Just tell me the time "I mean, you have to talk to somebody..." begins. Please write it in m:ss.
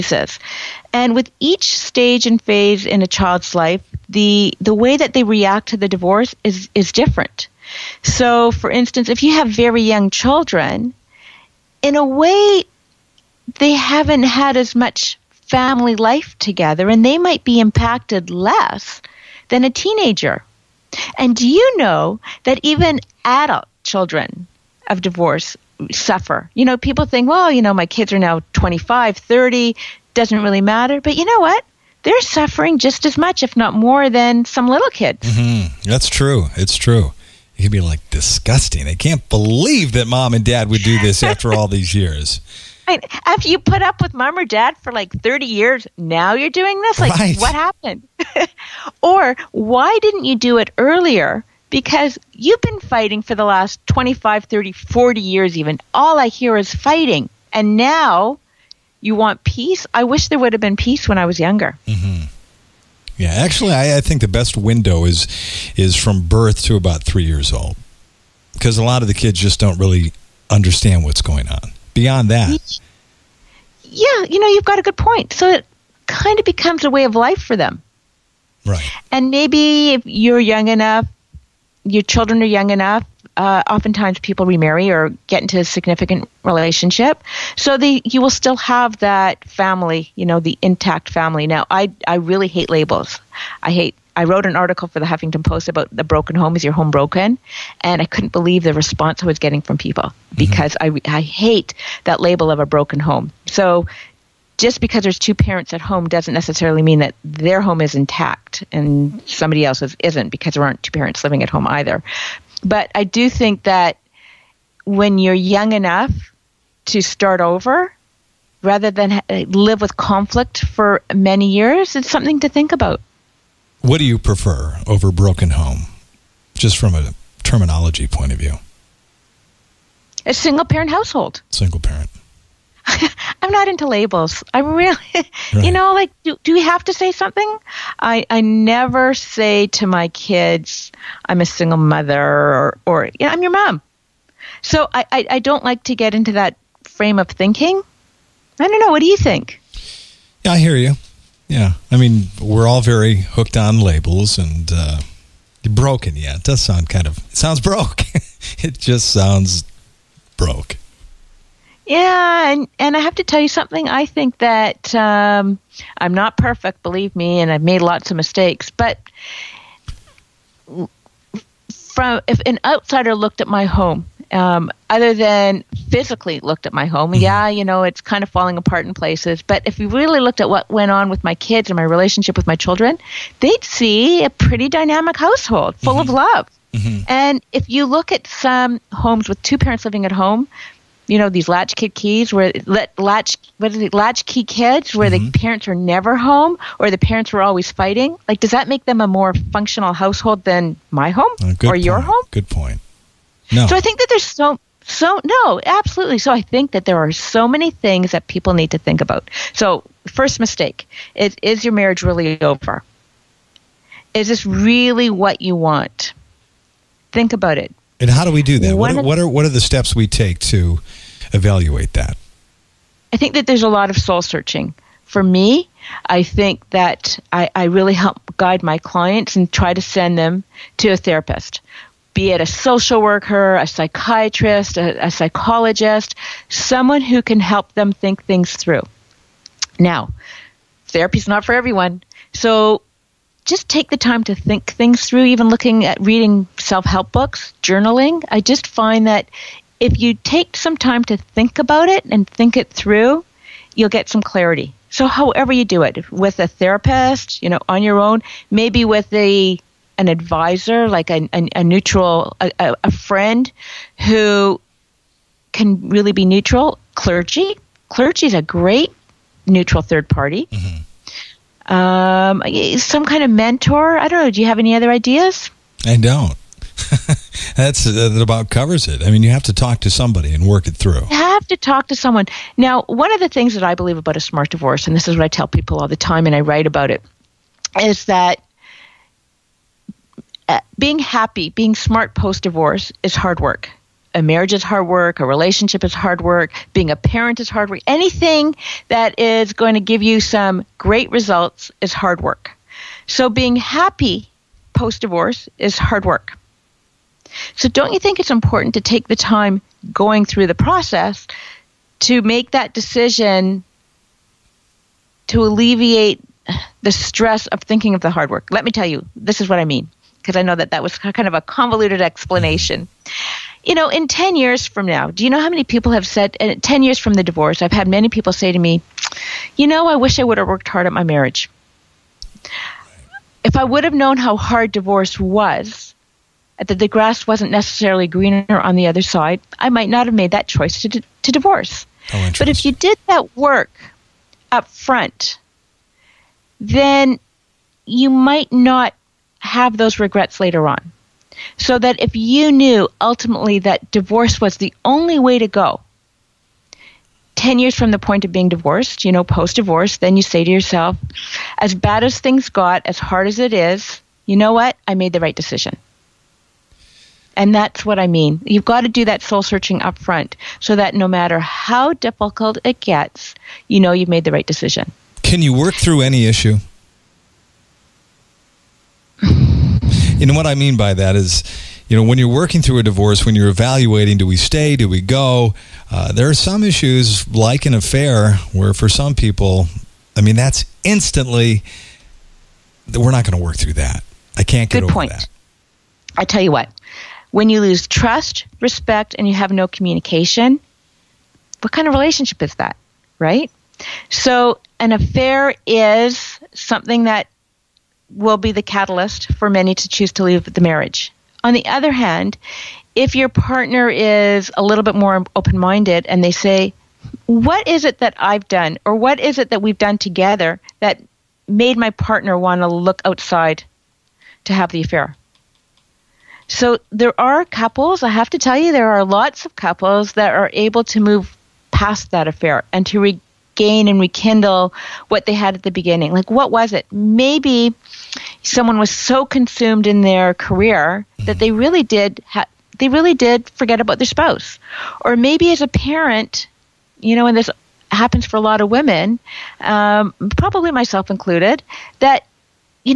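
4:39.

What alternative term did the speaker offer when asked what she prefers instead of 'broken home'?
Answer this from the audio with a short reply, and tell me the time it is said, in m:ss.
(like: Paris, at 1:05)
single parent household, at 2:10.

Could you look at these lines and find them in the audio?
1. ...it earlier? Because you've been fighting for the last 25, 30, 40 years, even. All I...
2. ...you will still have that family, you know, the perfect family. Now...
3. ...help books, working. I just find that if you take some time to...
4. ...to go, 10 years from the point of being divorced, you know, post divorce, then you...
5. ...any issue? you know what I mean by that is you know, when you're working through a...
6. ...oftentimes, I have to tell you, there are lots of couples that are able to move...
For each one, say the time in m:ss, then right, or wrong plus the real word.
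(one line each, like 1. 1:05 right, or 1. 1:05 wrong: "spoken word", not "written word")
1. 0:50 right
2. 1:28 wrong: "intact", not "perfect"
3. 4:06 wrong: "journaling", not "working"
4. 5:55 right
5. 6:16 right
6. 7:07 wrong: "couples", not "oftentimes".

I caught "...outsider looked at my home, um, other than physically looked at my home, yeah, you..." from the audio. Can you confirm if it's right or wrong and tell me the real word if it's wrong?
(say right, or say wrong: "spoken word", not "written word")
right.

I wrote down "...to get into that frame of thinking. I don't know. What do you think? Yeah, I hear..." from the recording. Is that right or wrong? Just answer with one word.
right.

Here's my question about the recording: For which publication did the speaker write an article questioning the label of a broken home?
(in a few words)
Huffington Post.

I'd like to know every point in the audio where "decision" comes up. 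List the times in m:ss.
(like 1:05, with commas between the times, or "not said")
5:12, 6:05, 6:14.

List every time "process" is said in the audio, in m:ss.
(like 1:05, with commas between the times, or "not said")
5:10.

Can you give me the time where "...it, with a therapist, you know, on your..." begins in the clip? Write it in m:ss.
4:15.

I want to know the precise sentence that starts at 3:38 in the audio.
What, what, are what are the steps we take to evaluate that?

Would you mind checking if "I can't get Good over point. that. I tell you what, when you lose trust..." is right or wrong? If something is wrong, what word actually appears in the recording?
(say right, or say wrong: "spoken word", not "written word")
right.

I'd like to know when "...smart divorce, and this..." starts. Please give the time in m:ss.
4:44.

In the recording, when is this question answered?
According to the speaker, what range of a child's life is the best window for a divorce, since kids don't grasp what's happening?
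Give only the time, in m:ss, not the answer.
1:05.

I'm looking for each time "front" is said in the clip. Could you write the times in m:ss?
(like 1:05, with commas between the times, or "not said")
5:44, 6:09.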